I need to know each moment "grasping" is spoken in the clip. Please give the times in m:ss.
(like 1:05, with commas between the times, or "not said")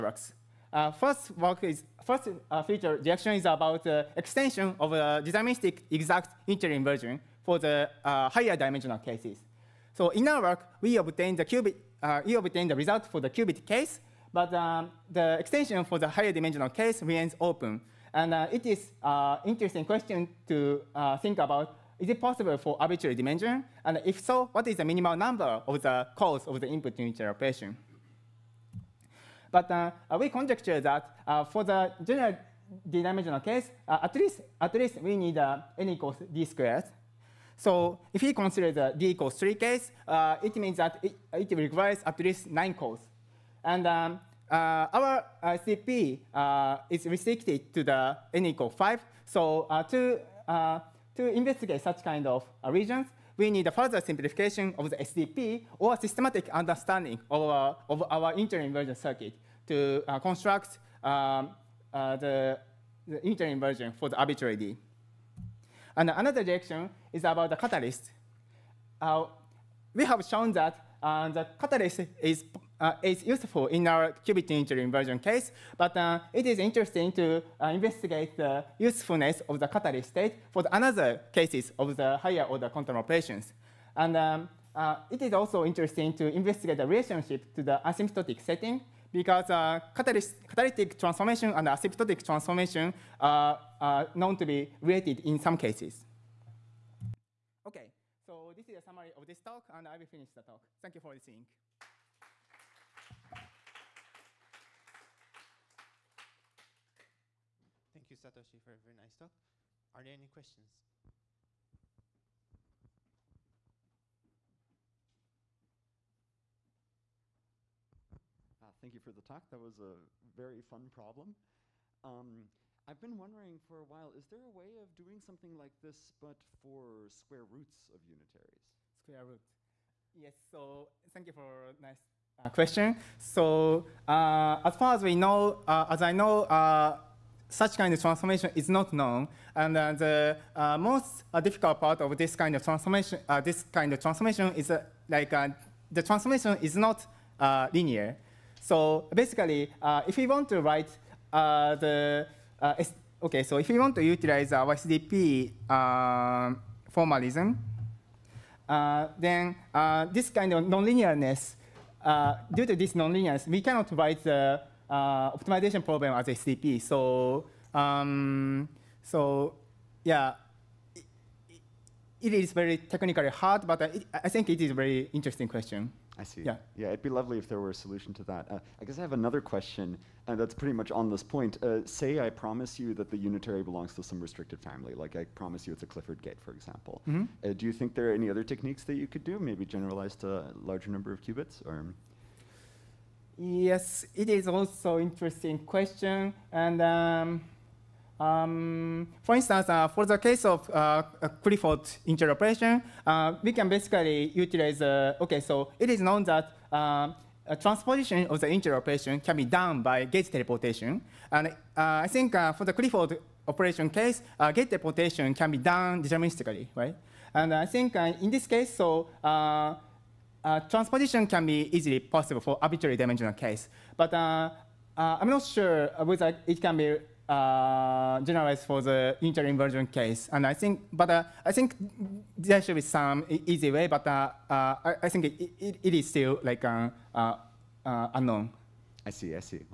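not said.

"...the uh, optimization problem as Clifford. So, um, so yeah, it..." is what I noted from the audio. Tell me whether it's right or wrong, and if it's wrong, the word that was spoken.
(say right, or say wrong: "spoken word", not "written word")
wrong: "SDP", not "Clifford".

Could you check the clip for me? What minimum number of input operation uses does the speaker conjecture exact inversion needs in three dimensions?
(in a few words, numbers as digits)
9.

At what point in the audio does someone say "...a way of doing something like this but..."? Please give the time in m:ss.
2:04.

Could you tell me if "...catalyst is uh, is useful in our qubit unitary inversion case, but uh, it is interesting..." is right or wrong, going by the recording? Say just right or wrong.
right.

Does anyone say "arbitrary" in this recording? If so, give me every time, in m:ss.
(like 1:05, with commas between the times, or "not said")
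0:22, 1:04, 3:42.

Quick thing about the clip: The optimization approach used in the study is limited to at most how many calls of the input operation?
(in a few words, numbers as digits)
5.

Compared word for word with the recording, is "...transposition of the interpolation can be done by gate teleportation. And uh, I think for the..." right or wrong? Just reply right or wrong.
right.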